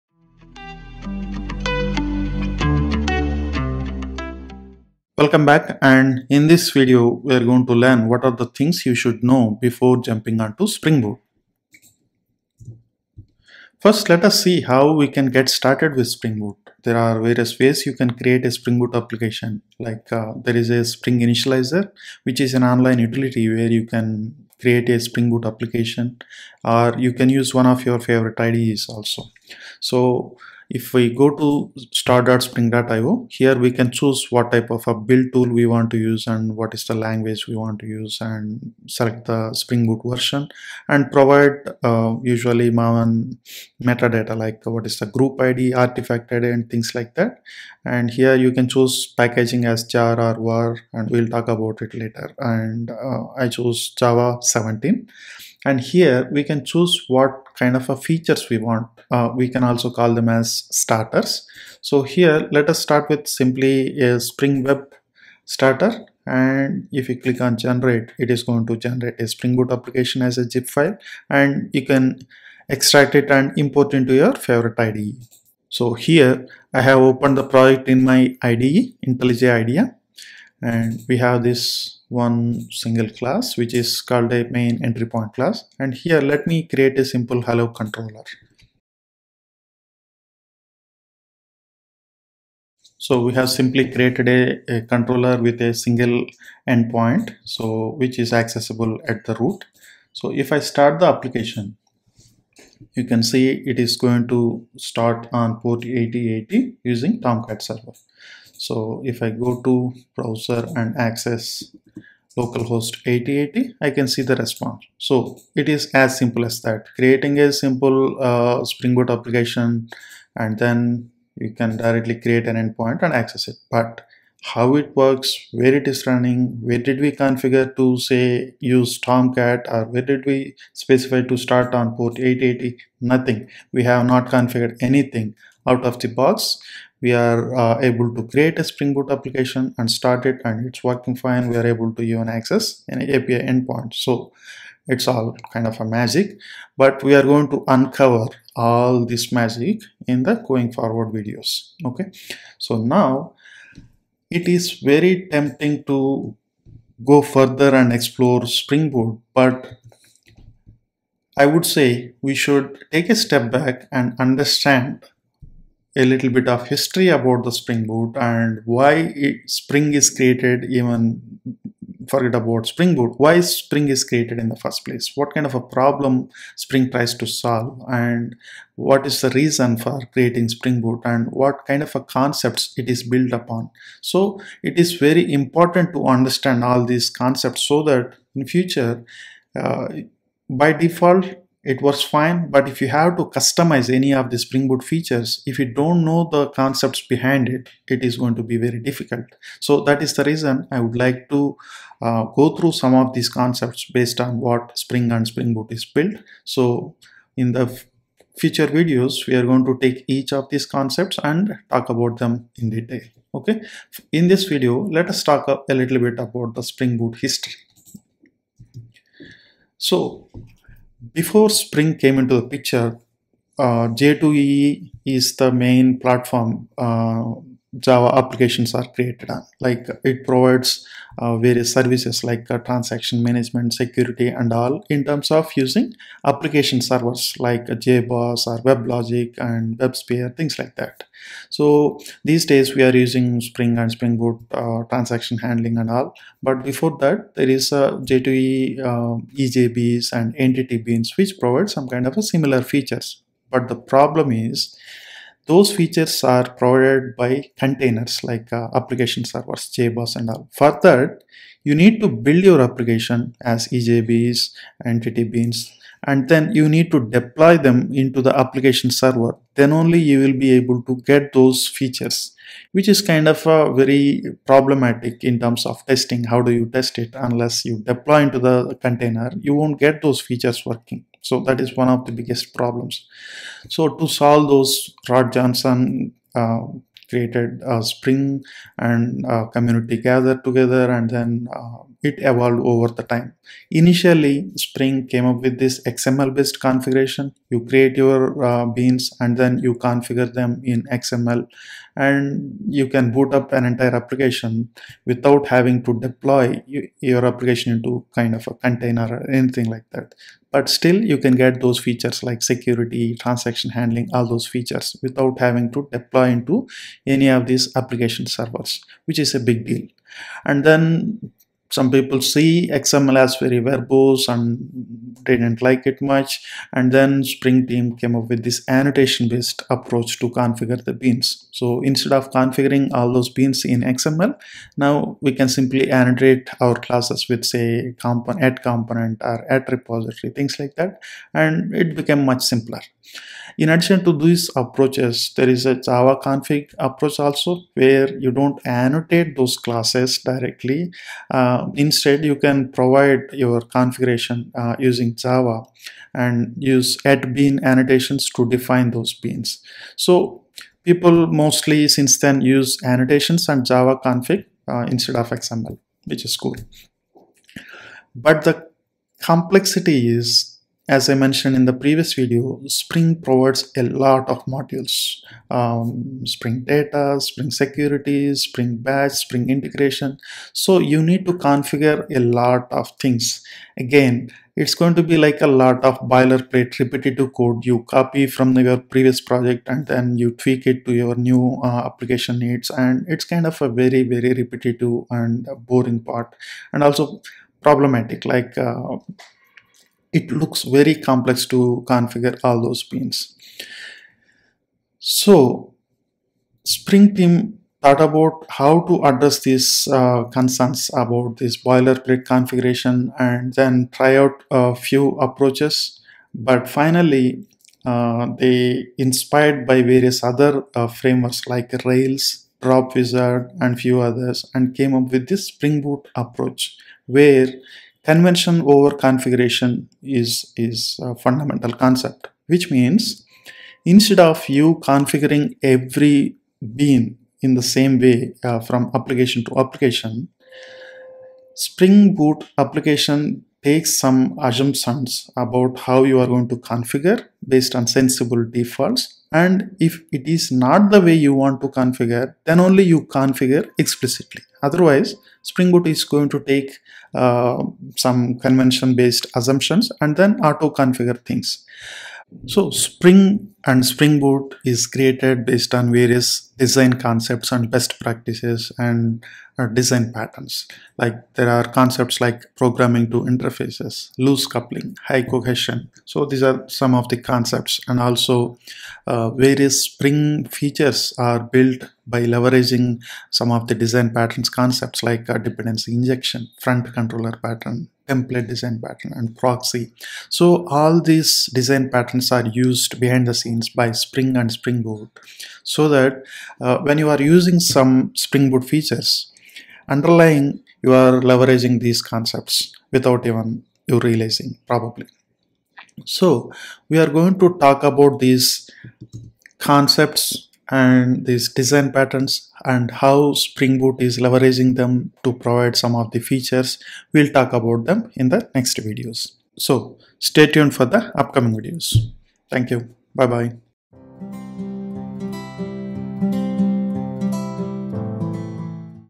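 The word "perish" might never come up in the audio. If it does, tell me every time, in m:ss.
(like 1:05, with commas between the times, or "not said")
not said.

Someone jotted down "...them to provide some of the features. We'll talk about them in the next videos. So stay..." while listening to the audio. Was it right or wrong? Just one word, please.
right.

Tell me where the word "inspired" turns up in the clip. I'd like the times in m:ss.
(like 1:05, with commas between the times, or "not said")
6:58.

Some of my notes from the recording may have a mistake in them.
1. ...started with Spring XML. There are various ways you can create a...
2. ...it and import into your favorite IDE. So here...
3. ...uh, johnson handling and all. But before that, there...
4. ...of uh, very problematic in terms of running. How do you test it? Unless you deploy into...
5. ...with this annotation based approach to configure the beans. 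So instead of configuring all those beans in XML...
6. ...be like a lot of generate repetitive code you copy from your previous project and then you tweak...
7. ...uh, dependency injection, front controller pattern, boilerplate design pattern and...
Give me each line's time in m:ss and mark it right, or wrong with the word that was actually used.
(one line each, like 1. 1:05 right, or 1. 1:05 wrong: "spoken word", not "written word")
1. 0:15 wrong: "Boot", not "XML"
2. 1:13 right
3. 4:04 wrong: "transaction", not "johnson"
4. 4:33 wrong: "testing", not "running"
5. 5:28 right
6. 6:25 wrong: "boilerplate", not "generate"
7. 8:05 wrong: "template", not "boilerplate".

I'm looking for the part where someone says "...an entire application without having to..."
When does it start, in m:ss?
5:03.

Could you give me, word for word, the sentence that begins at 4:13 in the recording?
But the problem is those features are provided by containers like uh, application servers, JBoss and all.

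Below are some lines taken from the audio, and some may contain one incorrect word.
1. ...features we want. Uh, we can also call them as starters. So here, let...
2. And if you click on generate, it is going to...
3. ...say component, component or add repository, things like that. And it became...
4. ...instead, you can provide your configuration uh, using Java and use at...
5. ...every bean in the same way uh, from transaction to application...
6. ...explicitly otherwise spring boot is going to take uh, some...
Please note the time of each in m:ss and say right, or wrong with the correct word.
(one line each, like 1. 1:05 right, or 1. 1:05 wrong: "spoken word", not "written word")
1. 0:58 right
2. 1:06 right
3. 5:37 right
4. 5:51 right
5. 7:15 wrong: "application", not "transaction"
6. 7:33 right.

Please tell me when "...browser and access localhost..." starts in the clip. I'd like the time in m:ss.
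1:50.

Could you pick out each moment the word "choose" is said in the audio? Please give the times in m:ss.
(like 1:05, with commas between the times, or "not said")
0:33, 0:48, 0:56.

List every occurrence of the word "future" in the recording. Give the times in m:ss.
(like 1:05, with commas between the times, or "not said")
3:08, 3:28.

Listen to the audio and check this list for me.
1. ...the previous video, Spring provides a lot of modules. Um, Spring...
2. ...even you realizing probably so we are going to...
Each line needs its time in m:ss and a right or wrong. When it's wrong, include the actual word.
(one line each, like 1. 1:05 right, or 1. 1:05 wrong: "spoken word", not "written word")
1. 6:11 right
2. 8:23 right.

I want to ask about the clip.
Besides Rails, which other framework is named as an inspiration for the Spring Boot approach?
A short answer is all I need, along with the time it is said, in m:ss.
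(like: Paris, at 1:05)
Dropwizard, at 7:02.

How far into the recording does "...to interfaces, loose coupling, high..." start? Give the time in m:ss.
7:53.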